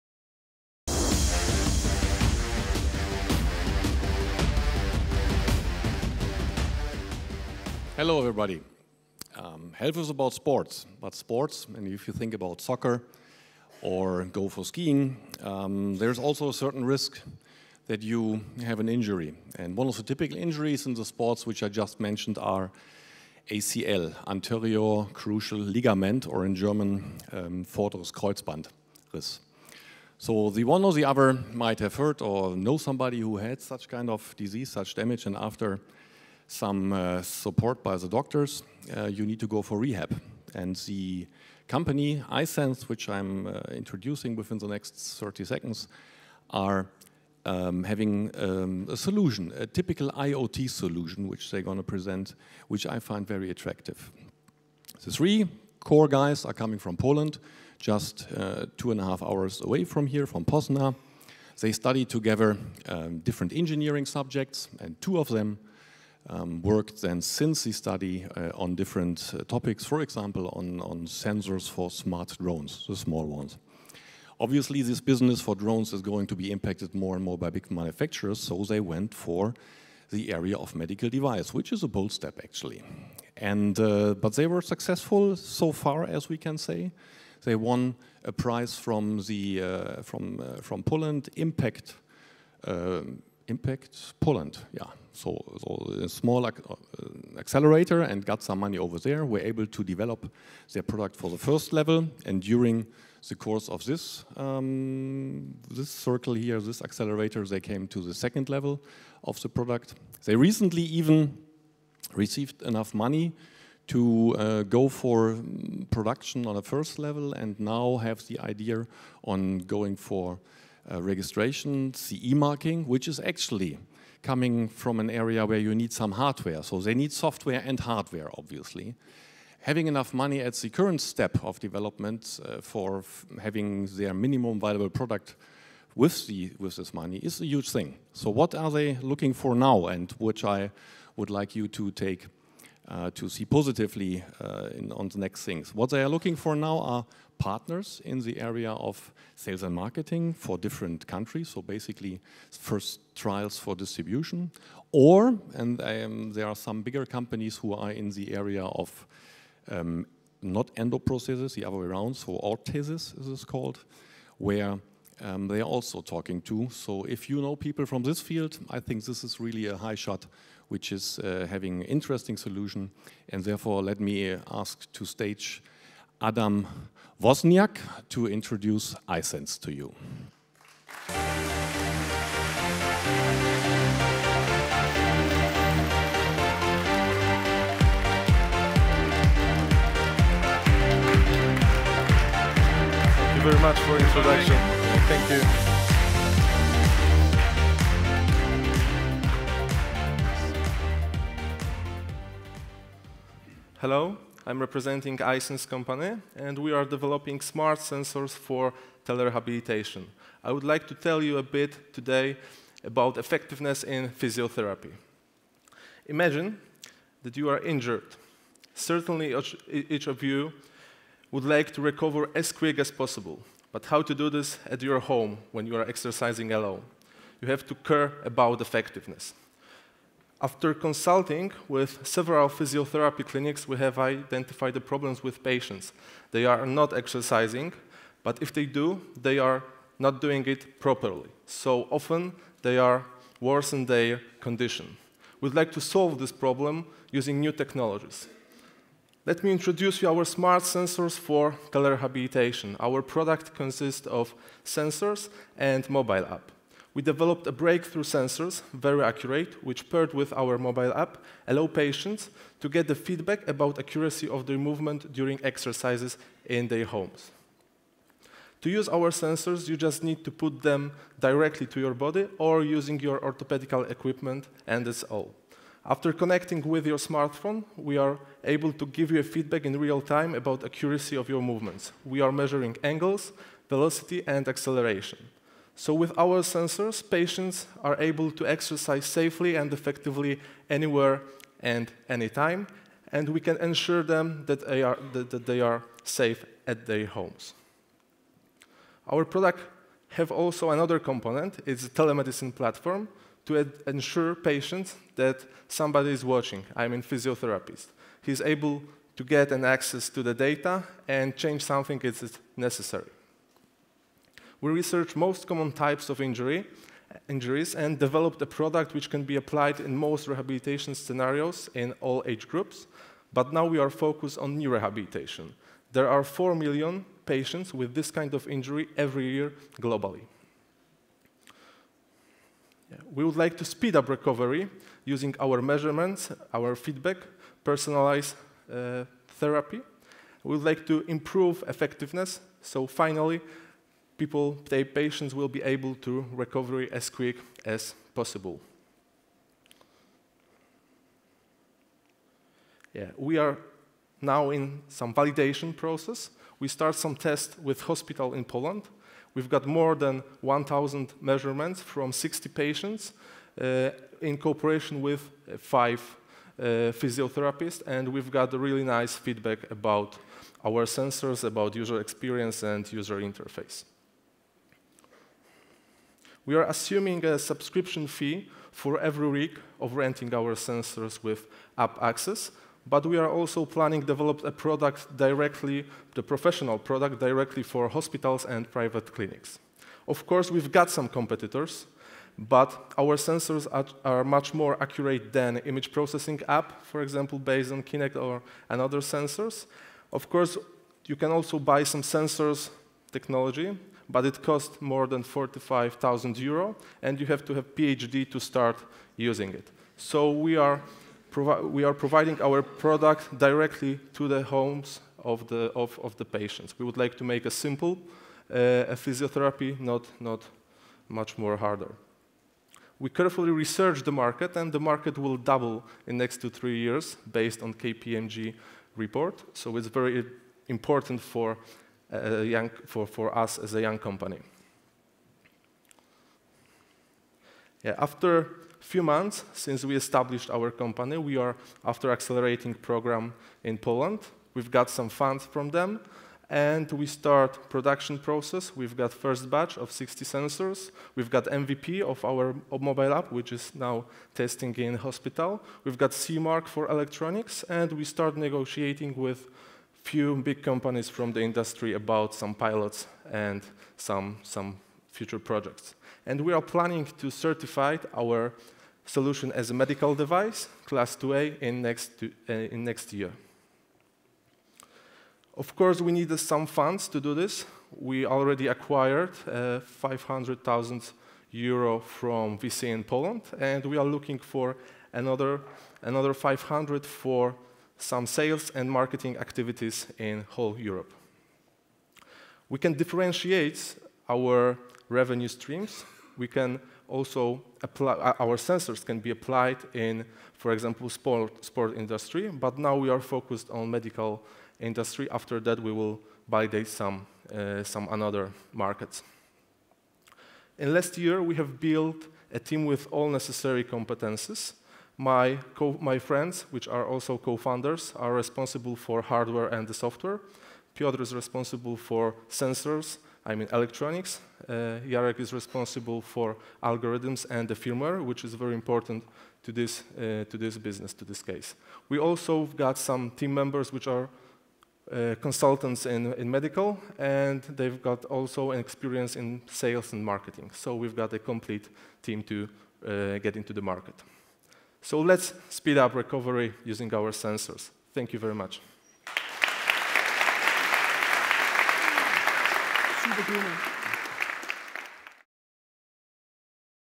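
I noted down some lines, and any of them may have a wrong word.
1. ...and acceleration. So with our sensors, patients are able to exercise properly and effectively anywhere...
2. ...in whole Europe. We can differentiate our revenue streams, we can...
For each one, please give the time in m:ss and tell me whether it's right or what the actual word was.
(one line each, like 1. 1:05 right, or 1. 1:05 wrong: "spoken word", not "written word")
1. 4:44 wrong: "safely", not "properly"
2. 8:10 right.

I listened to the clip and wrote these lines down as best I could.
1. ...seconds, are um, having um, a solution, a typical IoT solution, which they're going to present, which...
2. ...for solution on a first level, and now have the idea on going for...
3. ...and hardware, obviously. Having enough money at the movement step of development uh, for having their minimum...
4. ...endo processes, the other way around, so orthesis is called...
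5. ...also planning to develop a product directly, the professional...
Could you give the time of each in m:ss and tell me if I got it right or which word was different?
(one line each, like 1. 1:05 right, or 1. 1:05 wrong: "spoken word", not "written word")
1. 0:45 right
2. 1:54 wrong: "production", not "solution"
3. 2:07 wrong: "current", not "movement"
4. 2:40 right
5. 6:23 right.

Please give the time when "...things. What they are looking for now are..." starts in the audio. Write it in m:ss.
2:25.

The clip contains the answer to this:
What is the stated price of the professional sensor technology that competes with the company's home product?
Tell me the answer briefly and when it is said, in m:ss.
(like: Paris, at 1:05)
45,000 euro, at 6:45.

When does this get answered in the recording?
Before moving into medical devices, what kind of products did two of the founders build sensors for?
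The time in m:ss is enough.
1:11.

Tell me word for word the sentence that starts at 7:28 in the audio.
We've got first batch of 60 sensors.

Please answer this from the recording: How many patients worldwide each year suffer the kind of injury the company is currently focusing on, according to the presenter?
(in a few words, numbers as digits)
4 million.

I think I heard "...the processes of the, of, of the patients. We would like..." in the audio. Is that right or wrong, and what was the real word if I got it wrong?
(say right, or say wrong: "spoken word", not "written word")
wrong: "homes", not "processes".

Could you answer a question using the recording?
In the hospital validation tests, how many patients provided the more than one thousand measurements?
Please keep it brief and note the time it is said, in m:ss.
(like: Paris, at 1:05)
60, at 6:02.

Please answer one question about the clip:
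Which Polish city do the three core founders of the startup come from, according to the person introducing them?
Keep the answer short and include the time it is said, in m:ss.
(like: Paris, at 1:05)
Poznań, at 1:00.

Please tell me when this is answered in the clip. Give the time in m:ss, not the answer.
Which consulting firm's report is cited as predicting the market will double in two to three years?
7:07.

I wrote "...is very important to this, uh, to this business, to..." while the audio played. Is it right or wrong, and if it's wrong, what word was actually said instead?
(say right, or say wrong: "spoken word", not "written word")
right.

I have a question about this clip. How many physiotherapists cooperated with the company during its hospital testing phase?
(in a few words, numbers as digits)
5.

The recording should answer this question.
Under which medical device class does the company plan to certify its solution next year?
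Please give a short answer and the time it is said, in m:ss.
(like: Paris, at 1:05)
class 2A, at 7:50.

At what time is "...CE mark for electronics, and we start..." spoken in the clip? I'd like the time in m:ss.
7:36.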